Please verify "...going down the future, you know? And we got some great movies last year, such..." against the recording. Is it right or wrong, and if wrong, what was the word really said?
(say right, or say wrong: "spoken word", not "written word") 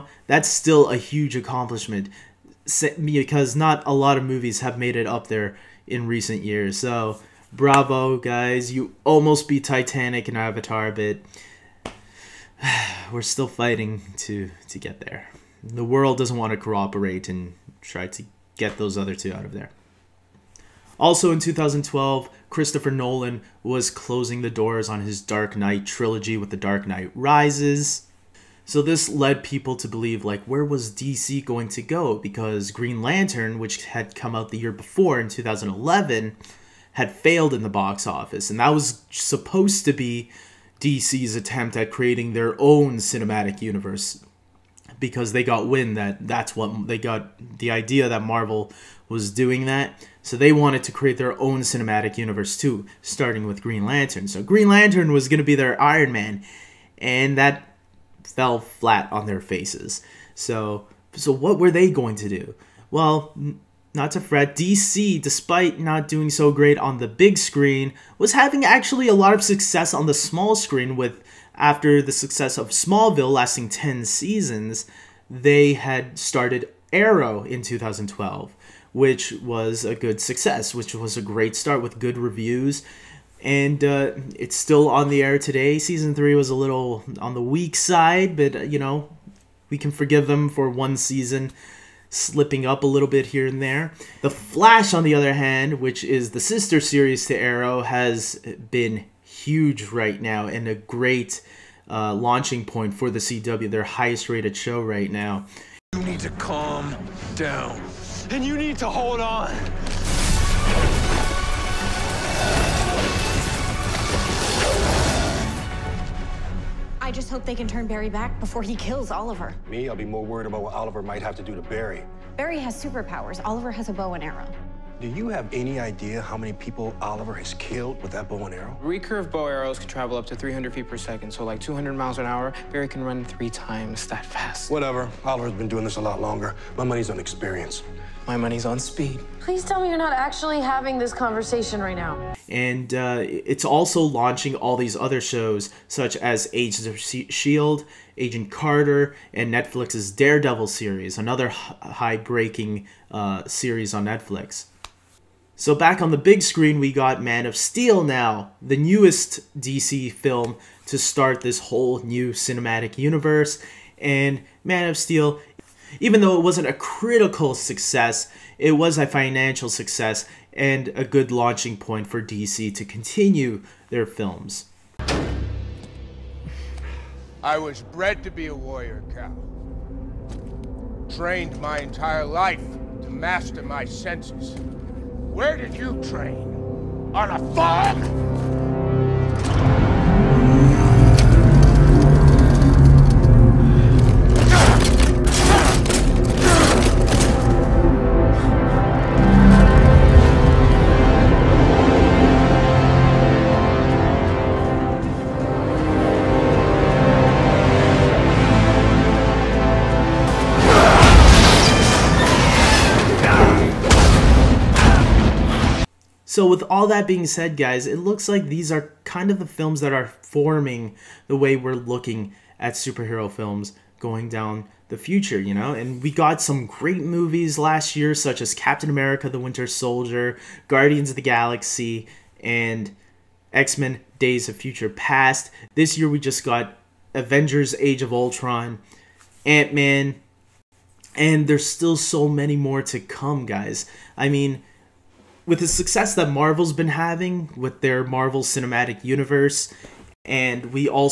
right.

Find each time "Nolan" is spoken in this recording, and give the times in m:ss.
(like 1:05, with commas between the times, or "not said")
0:22.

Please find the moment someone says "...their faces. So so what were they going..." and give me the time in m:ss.
0:59.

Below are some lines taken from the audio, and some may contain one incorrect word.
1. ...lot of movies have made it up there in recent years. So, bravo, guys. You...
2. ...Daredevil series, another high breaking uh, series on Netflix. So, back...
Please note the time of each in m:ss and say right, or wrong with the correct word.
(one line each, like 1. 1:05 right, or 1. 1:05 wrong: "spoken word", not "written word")
1. 0:03 right
2. 2:30 right.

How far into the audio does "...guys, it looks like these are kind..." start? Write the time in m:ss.
3:37.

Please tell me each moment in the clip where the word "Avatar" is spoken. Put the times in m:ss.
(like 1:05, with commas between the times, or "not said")
0:10.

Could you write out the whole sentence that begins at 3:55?
This year we just got Avengers Age of Ultron, Ant Man, and there's still so many more to come, guys.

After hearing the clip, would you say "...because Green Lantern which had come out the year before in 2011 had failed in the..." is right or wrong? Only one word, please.
right.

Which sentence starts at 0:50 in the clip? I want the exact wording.
So they wanted to create their own cinematic universe too, starting with Green Lantern.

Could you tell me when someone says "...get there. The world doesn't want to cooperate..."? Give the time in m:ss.
0:14.